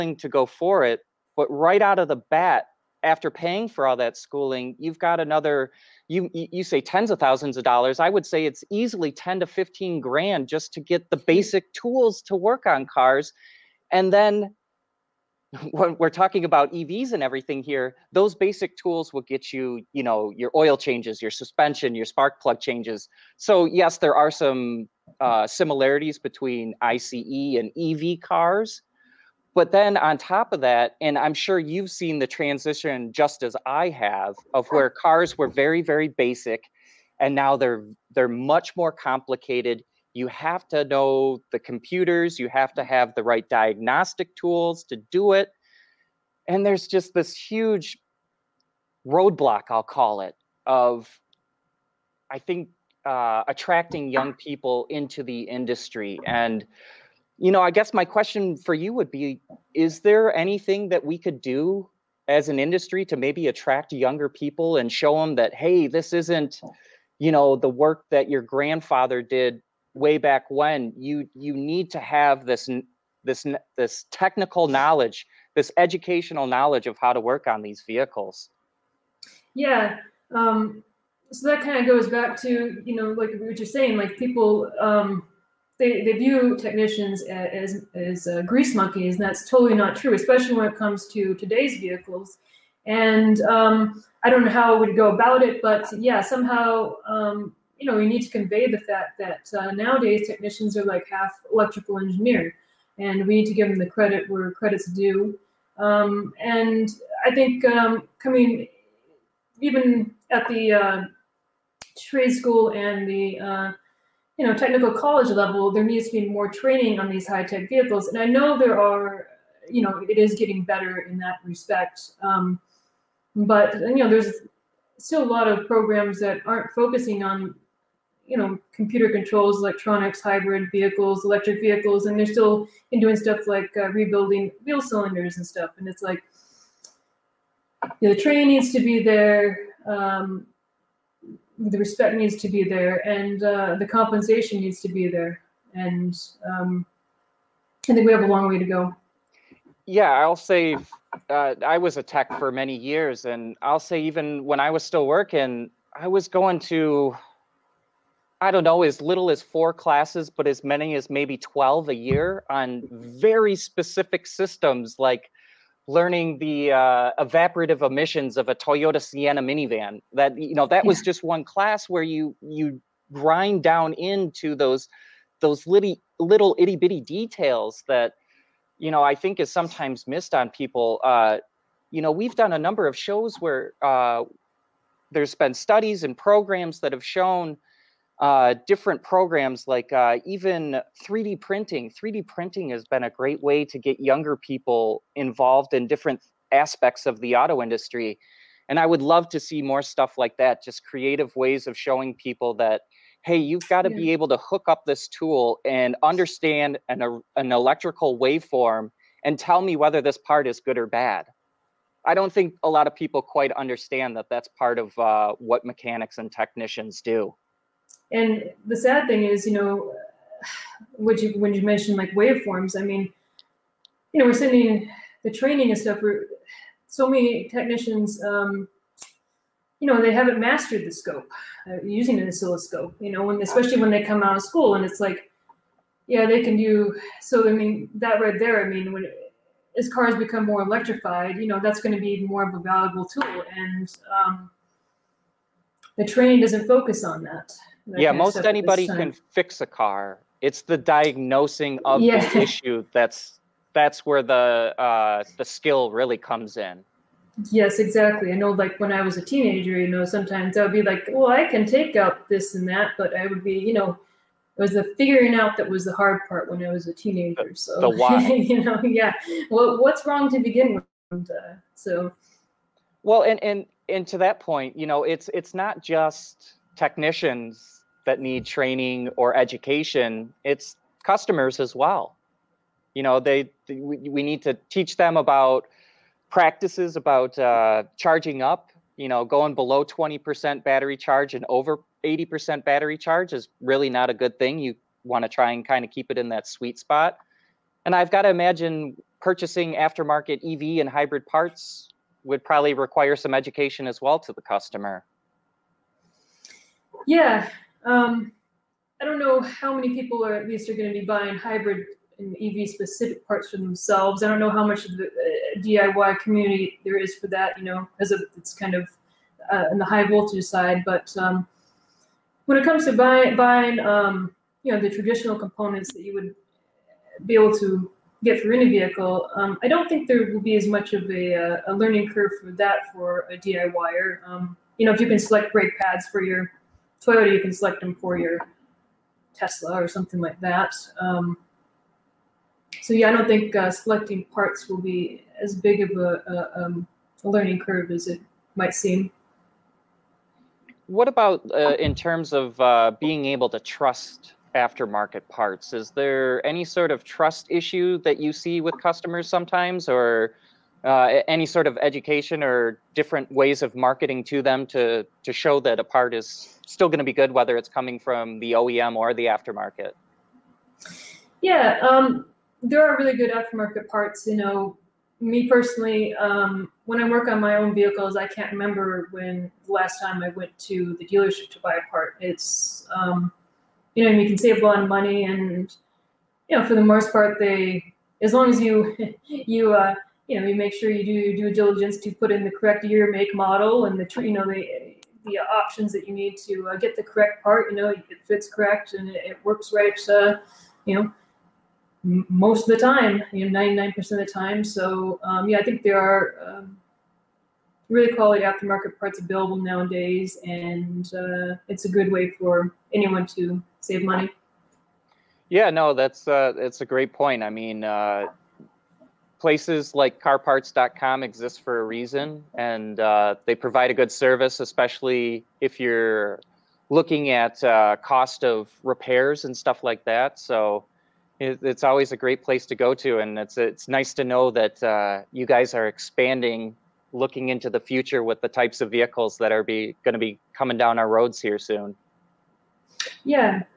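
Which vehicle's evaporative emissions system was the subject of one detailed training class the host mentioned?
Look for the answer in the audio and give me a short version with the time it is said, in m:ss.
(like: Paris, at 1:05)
Toyota Sienna, at 2:48.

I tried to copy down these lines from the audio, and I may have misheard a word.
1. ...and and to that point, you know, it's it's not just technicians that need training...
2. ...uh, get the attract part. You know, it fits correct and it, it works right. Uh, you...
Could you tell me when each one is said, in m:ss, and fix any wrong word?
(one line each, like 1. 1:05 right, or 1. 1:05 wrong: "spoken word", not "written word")
1. 4:33 right
2. 6:36 wrong: "correct", not "attract".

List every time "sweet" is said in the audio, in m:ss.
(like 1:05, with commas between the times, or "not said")
4:56.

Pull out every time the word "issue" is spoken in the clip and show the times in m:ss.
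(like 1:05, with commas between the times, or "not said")
4:12, 5:57.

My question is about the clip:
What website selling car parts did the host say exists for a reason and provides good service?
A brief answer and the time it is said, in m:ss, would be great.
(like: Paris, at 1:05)
carparts.com, at 7:00.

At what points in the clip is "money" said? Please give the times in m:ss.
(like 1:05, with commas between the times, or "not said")
6:24, 6:54.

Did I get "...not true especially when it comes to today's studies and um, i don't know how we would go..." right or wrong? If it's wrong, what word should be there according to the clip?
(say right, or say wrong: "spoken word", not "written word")
wrong: "vehicles", not "studies".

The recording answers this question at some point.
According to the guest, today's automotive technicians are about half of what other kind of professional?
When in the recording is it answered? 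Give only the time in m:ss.
1:41.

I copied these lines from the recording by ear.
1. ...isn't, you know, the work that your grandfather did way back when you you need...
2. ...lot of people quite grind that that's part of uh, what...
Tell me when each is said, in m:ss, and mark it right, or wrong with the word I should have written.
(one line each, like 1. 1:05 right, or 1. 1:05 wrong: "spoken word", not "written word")
1. 1:06 right
2. 3:32 wrong: "understand", not "grind".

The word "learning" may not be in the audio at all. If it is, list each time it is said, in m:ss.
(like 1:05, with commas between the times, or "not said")
2:45, 5:31, 5:47.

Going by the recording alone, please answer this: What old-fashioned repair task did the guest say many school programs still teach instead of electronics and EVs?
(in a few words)
Rebuilding wheel cylinders.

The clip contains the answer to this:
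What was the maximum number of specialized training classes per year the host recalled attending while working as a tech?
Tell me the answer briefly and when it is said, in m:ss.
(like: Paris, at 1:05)
12, at 2:41.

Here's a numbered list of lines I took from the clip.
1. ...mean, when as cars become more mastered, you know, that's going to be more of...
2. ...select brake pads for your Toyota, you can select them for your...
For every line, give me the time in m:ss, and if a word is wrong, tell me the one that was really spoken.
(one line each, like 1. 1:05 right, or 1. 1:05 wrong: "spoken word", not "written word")
1. 3:58 wrong: "electrified", not "mastered"
2. 5:35 right.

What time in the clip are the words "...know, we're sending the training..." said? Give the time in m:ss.
3:44.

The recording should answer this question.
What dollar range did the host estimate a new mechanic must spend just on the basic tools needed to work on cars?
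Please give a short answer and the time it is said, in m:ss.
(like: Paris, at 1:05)
$10,000 to $15,000, at 0:09.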